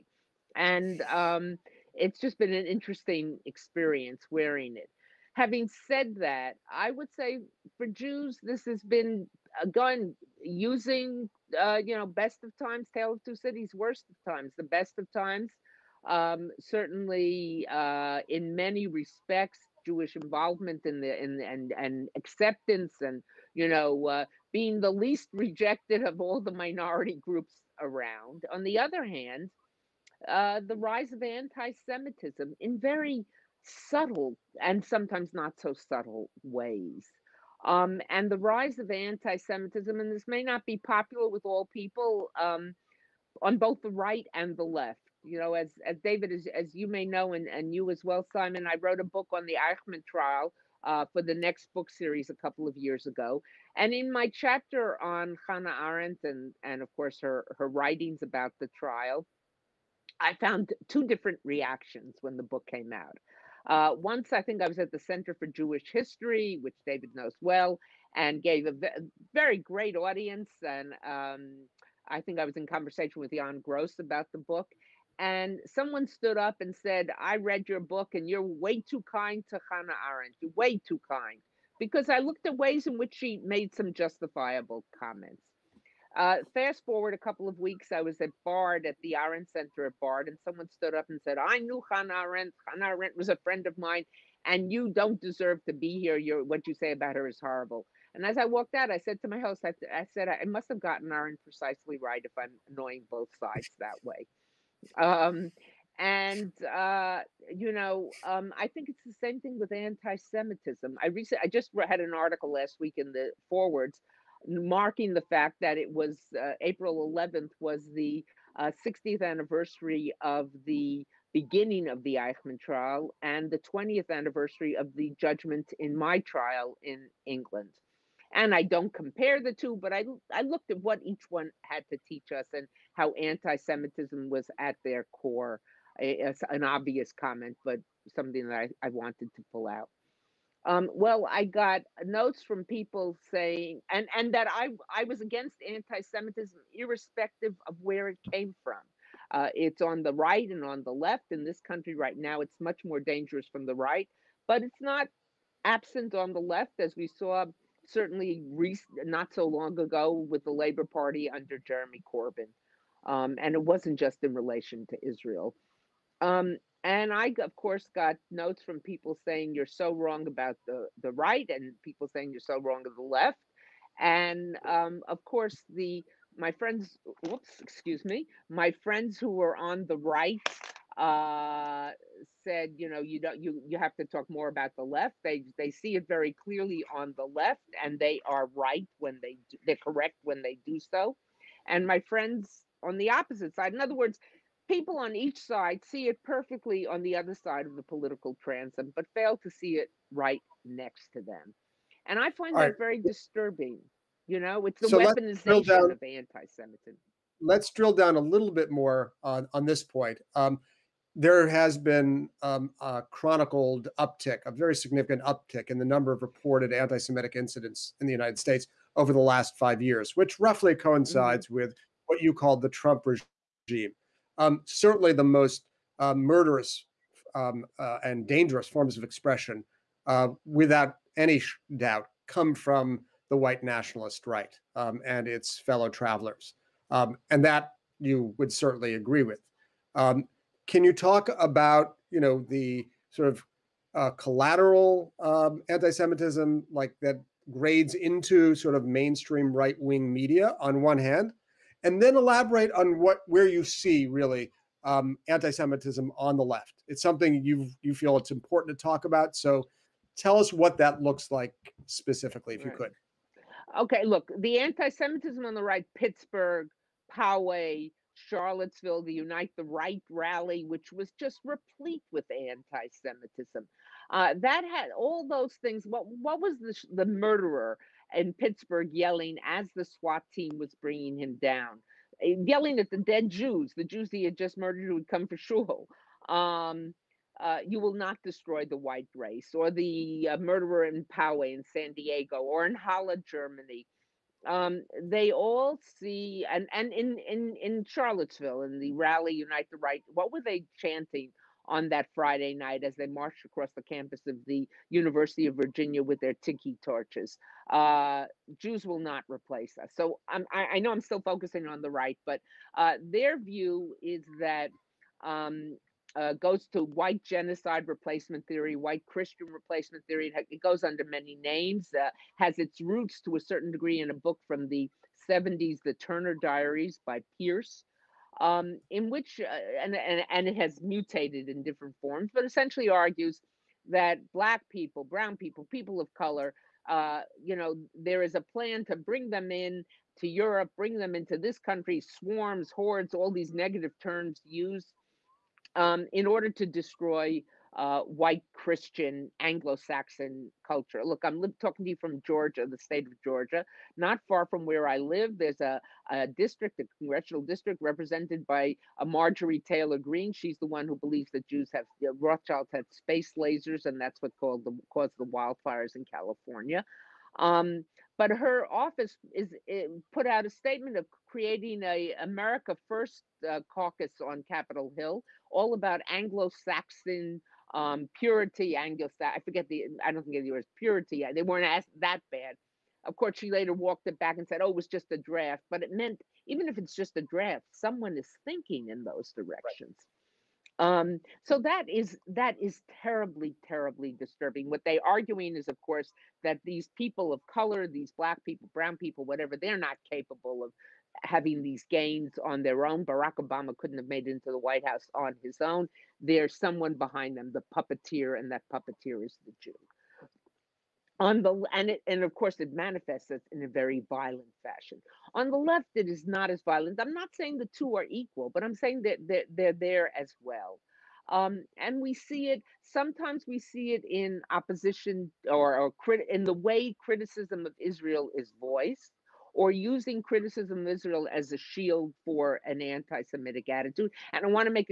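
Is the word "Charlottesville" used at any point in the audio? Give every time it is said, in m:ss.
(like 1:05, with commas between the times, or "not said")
4:28, 4:57.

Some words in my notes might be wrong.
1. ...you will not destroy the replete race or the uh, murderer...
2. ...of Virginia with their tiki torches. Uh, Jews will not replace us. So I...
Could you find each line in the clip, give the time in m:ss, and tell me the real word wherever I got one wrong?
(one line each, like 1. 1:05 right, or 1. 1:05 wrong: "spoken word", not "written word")
1. 4:47 wrong: "white", not "replete"
2. 5:05 right.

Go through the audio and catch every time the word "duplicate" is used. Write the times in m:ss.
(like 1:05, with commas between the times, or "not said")
not said.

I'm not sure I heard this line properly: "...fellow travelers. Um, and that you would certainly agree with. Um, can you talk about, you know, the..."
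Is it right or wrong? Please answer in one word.
right.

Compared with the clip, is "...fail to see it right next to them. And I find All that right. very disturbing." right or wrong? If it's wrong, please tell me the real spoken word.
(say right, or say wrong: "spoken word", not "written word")
right.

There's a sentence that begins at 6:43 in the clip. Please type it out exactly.
Barack Obama couldn't have made it into the White House on his own.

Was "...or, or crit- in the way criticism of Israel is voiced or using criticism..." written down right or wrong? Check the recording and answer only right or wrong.
right.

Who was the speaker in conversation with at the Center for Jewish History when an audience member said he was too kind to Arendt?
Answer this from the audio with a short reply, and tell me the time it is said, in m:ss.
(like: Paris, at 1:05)
Jan Gross, at 1:13.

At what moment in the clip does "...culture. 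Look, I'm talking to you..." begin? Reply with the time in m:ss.
5:50.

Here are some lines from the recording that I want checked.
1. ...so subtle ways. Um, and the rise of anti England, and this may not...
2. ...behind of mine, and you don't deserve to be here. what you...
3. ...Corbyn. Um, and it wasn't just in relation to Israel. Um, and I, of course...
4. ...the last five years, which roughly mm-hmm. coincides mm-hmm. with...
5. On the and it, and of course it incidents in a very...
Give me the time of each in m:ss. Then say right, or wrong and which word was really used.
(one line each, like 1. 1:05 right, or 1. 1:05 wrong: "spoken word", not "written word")
1. 0:35 wrong: "Semitism", not "England"
2. 1:33 wrong: "friend", not "behind"
3. 2:42 right
4. 3:39 right
5. 6:51 wrong: "manifests", not "incidents".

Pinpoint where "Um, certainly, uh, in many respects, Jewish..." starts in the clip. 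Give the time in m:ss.
0:16.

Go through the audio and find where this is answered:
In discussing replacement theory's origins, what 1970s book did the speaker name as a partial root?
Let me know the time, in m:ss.
5:25.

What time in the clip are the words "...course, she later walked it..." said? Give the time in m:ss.
6:23.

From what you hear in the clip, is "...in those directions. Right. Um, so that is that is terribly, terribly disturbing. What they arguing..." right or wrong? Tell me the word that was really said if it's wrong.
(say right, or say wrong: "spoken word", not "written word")
right.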